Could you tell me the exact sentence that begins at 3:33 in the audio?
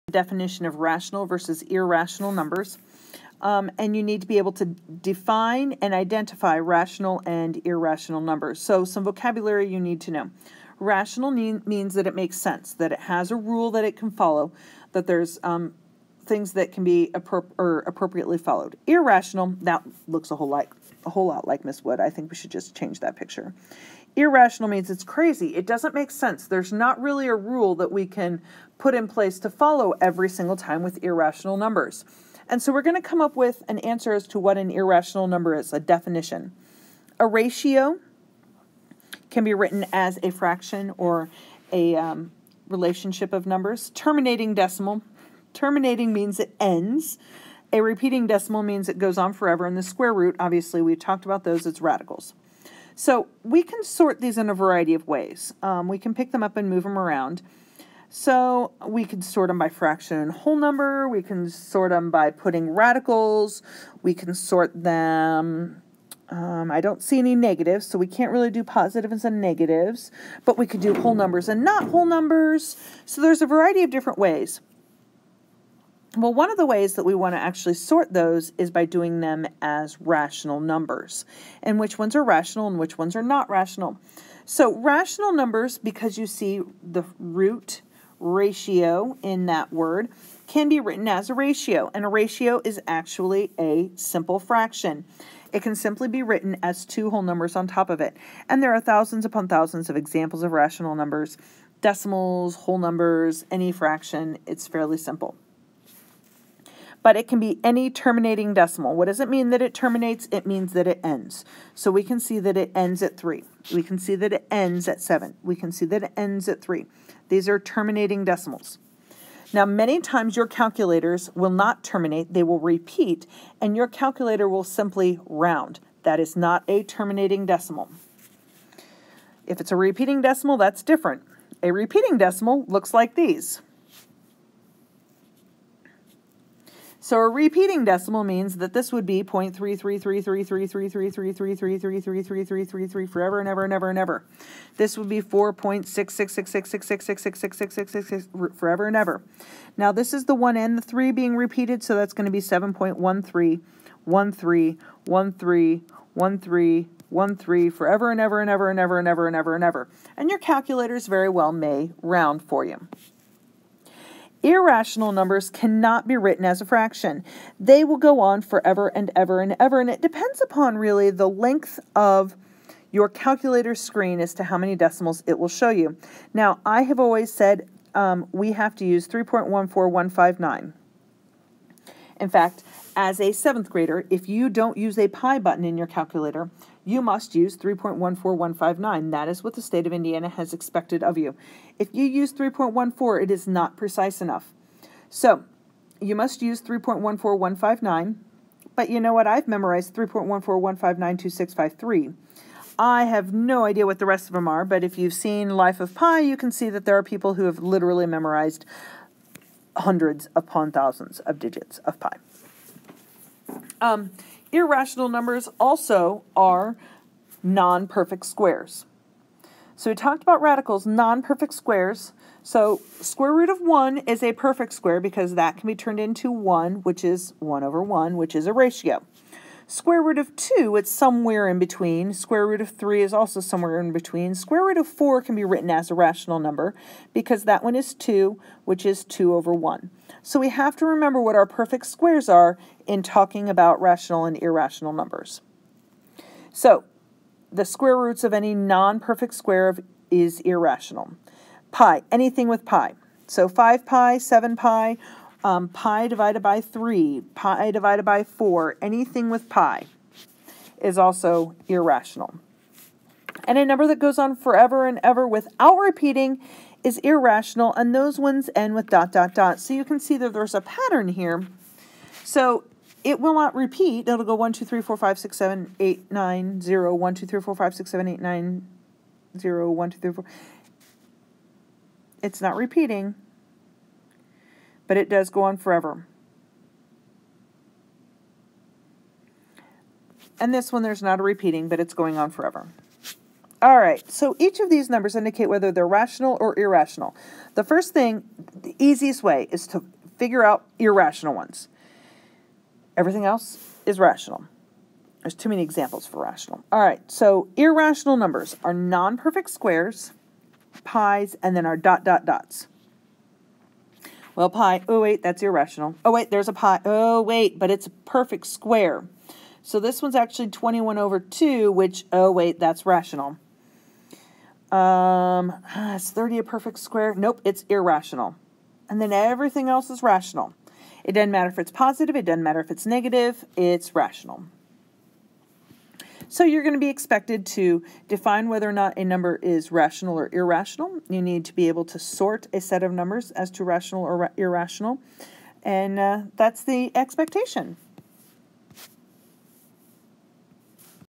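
Um, irrational numbers also are non-perfect squares.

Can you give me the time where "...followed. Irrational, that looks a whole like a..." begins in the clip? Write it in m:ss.
0:18.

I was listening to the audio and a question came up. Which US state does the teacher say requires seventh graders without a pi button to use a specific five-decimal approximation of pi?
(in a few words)
Indiana.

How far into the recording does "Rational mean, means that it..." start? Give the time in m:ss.
0:10.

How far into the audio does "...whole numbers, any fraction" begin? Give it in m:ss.
1:42.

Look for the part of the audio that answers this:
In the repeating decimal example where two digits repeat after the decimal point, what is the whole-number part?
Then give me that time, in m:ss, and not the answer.
2:32.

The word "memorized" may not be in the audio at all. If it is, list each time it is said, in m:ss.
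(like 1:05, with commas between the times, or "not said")
3:19, 3:28.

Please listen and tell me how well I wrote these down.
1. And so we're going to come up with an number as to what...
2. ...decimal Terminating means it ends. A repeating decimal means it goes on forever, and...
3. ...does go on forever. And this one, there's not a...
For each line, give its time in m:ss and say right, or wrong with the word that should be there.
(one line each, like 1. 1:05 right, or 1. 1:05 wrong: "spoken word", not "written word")
1. 0:32 wrong: "answer", not "number"
2. 0:44 right
3. 4:45 right.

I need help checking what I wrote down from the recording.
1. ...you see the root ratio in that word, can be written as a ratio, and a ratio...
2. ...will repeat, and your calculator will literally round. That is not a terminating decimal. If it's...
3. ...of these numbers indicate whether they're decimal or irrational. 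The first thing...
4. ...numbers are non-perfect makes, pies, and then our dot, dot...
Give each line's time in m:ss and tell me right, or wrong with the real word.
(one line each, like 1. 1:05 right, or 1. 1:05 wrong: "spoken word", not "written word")
1. 1:26 right
2. 2:02 wrong: "simply", not "literally"
3. 4:54 wrong: "rational", not "decimal"
4. 5:08 wrong: "squares", not "makes".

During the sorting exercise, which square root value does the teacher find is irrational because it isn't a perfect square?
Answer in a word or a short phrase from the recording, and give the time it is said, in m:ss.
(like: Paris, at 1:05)
30, at 5:26.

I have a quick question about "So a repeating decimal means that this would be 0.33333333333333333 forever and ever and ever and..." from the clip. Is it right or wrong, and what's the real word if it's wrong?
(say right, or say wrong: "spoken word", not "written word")
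right.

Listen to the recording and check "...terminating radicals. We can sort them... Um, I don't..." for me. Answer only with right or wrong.
wrong.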